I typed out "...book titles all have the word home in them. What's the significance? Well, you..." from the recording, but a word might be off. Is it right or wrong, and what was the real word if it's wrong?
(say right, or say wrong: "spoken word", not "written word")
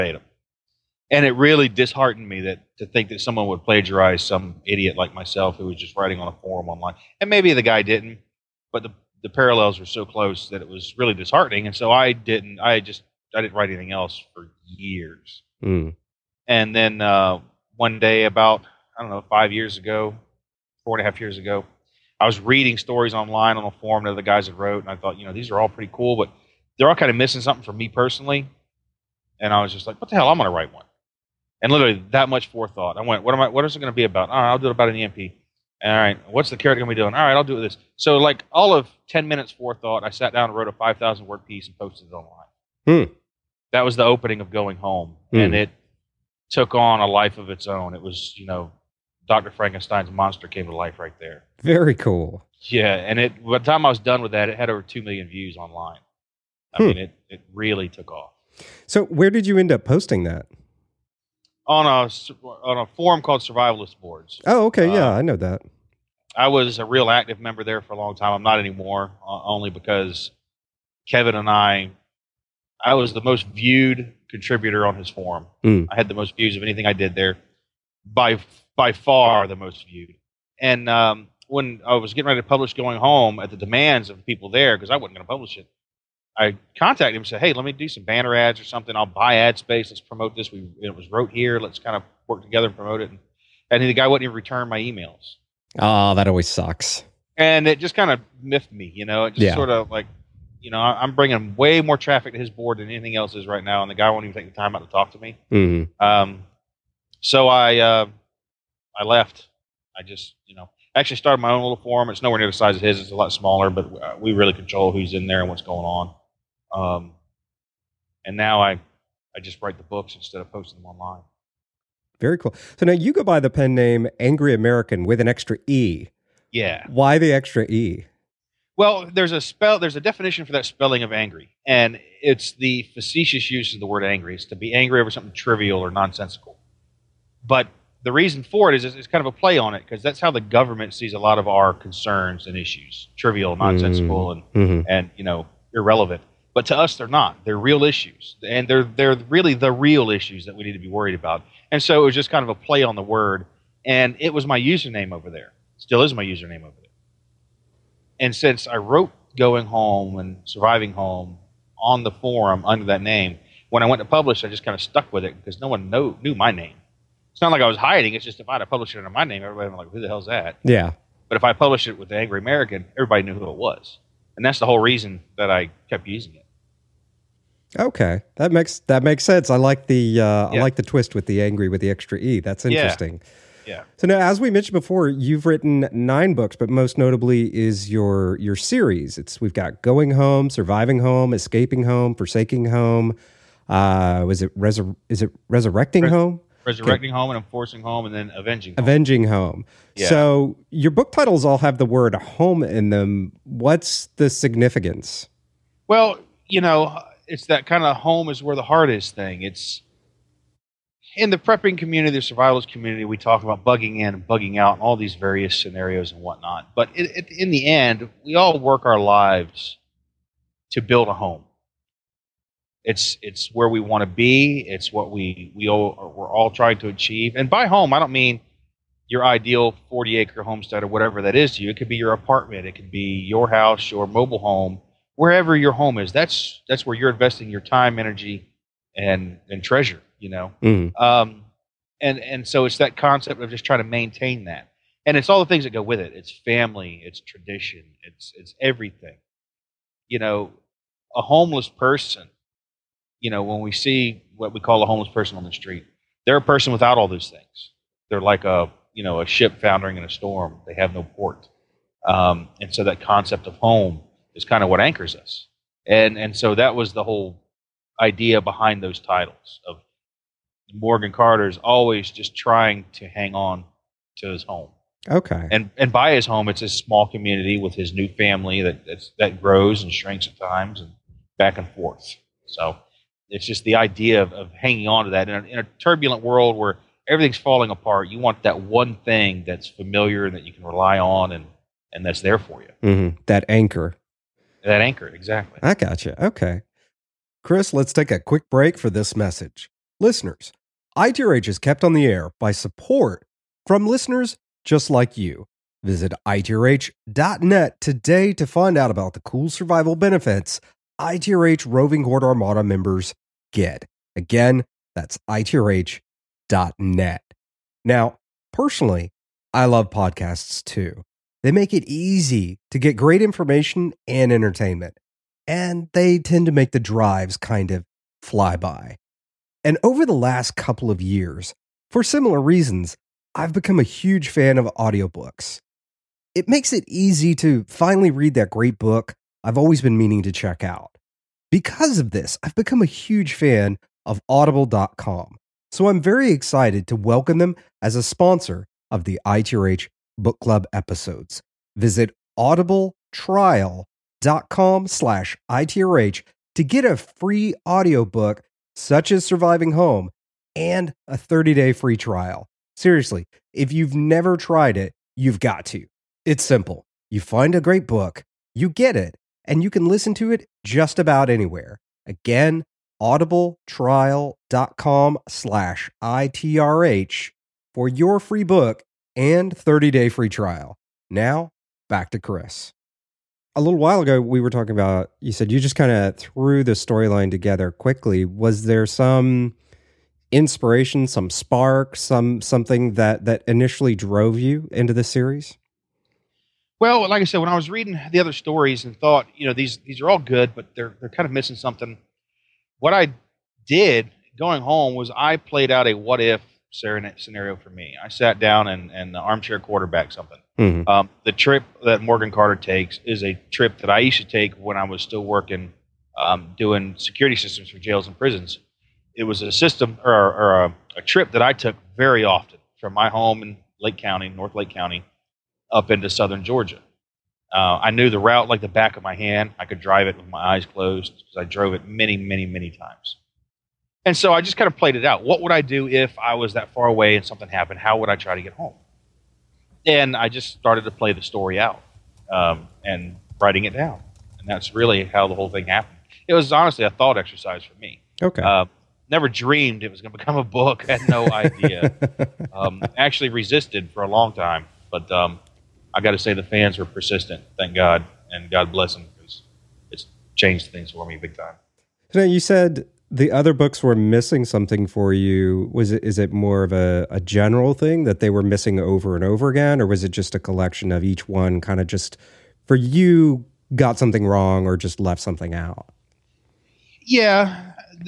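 right.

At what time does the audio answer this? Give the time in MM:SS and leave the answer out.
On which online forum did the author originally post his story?
01:03.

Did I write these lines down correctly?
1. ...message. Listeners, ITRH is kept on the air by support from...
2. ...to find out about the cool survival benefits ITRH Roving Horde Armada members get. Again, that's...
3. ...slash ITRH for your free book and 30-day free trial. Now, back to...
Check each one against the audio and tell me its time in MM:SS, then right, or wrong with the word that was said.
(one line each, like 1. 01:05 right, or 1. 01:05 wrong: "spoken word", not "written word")
1. 04:59 right
2. 05:08 right
3. 06:15 right.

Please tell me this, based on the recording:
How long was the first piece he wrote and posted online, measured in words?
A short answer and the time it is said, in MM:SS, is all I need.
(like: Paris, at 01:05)
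5,000 words, at 00:40.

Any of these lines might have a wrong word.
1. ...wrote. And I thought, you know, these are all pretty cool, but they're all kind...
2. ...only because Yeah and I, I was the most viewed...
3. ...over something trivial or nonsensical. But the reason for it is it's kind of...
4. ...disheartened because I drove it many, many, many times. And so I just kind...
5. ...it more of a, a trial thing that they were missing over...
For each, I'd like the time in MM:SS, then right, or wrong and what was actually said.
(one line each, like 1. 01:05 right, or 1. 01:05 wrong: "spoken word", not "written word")
1. 00:24 right
2. 01:09 wrong: "Kevin", not "Yeah"
3. 02:15 right
4. 07:10 wrong: "closed", not "disheartened"
5. 07:46 wrong: "general", not "trial".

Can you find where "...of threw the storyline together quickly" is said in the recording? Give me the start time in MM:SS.
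06:25.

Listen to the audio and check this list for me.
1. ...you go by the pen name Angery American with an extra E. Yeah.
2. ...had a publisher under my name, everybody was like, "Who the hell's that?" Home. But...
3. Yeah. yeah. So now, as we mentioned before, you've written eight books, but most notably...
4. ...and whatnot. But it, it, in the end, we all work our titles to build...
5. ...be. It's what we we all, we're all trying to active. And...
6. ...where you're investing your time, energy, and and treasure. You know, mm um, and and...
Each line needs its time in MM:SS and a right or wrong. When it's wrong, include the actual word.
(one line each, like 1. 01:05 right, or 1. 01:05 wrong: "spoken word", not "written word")
1. 02:02 right
2. 02:48 wrong: "Yeah", not "Home"
3. 03:03 wrong: "nine", not "eight"
4. 03:36 wrong: "lives", not "titles"
5. 03:44 wrong: "achieve", not "active"
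6. 03:56 right.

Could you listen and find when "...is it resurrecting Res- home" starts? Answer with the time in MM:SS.
03:15.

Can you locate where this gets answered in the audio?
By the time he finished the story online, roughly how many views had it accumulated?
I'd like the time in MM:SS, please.
00:54.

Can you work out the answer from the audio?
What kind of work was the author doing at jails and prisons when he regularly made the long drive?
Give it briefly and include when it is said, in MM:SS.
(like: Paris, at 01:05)
security systems, at 06:56.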